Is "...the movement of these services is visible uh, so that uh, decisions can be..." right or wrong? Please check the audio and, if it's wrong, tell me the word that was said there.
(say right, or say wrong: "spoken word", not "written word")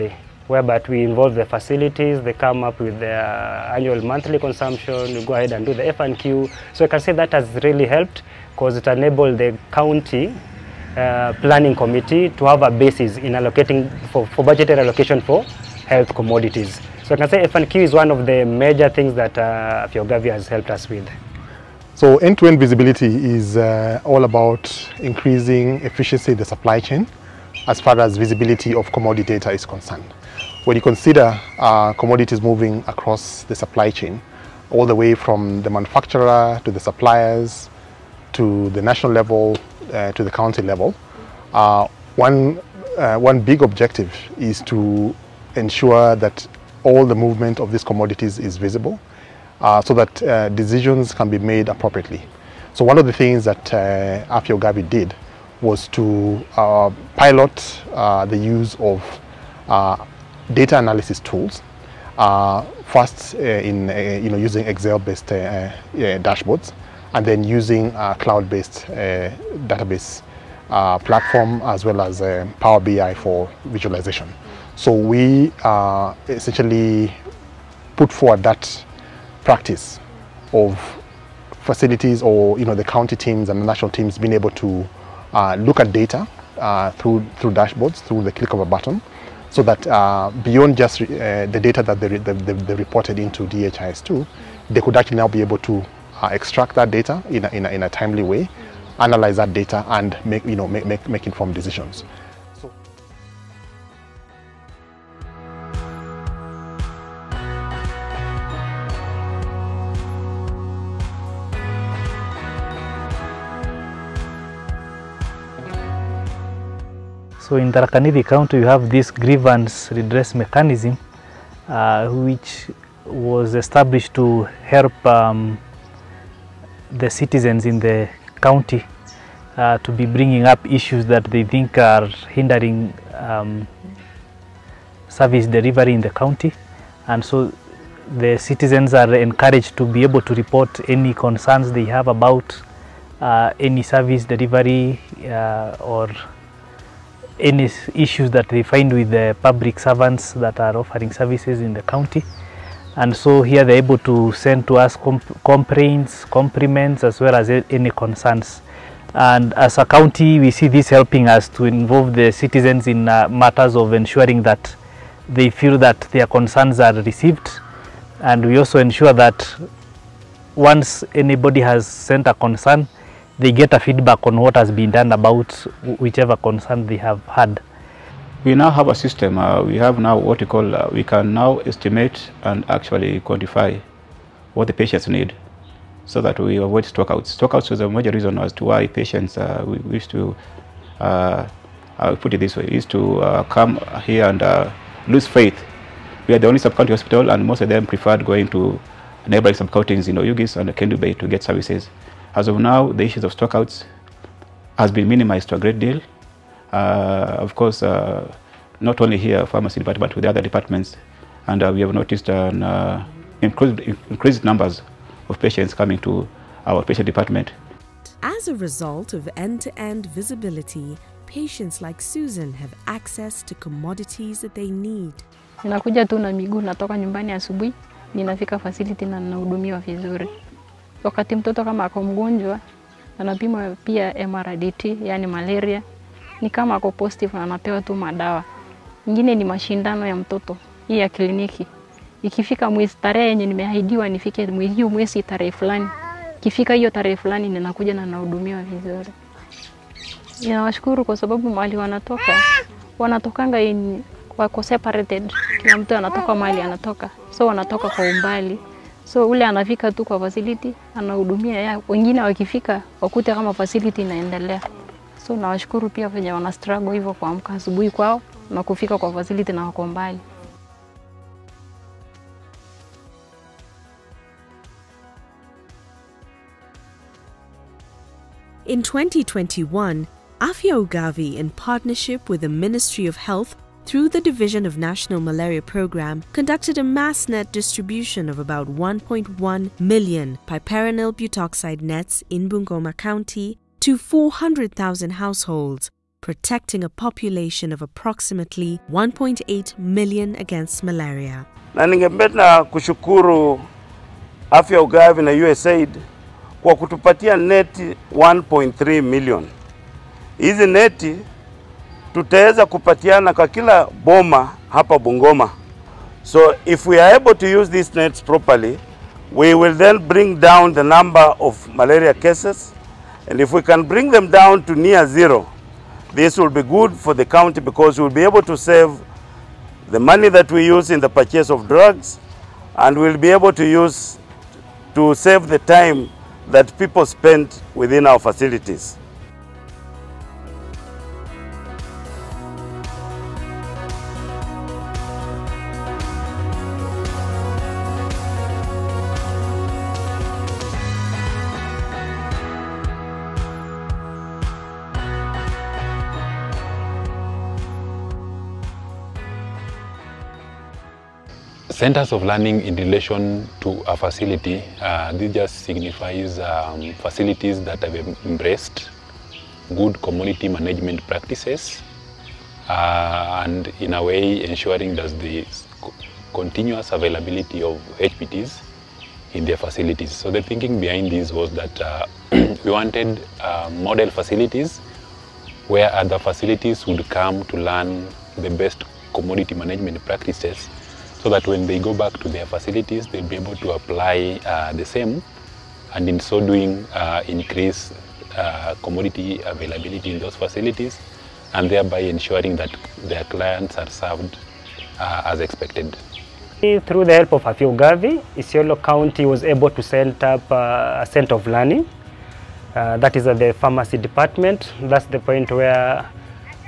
wrong: "commodities", not "services".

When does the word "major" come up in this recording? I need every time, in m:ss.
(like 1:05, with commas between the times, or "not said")
0:18, 3:07.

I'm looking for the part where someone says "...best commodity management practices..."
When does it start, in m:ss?
6:28.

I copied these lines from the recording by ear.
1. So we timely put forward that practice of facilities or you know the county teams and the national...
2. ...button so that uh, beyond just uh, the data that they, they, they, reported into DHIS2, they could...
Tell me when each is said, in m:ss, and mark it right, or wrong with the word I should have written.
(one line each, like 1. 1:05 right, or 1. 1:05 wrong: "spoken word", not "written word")
1. 1:14 wrong: "essentially", not "timely"
2. 1:28 right.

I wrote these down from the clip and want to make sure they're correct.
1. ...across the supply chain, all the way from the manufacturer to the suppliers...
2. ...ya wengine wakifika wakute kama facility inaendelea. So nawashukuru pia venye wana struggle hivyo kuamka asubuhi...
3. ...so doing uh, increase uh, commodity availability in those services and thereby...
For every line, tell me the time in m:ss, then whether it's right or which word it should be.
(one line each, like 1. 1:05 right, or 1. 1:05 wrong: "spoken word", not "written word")
1. 0:32 right
2. 4:21 right
3. 6:36 wrong: "facilities", not "services".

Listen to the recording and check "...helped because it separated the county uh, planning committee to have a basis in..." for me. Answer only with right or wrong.
wrong.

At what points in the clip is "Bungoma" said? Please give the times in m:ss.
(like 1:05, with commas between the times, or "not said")
4:52, 5:14.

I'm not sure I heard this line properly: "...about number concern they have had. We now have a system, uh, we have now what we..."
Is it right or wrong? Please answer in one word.
wrong.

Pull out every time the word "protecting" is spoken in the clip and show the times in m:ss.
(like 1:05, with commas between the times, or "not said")
4:56.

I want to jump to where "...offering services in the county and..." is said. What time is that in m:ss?
2:30.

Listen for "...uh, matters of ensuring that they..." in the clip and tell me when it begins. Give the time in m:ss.
2:43.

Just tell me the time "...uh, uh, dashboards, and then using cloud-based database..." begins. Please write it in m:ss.
1:05.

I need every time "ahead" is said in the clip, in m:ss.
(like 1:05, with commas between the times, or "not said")
0:05.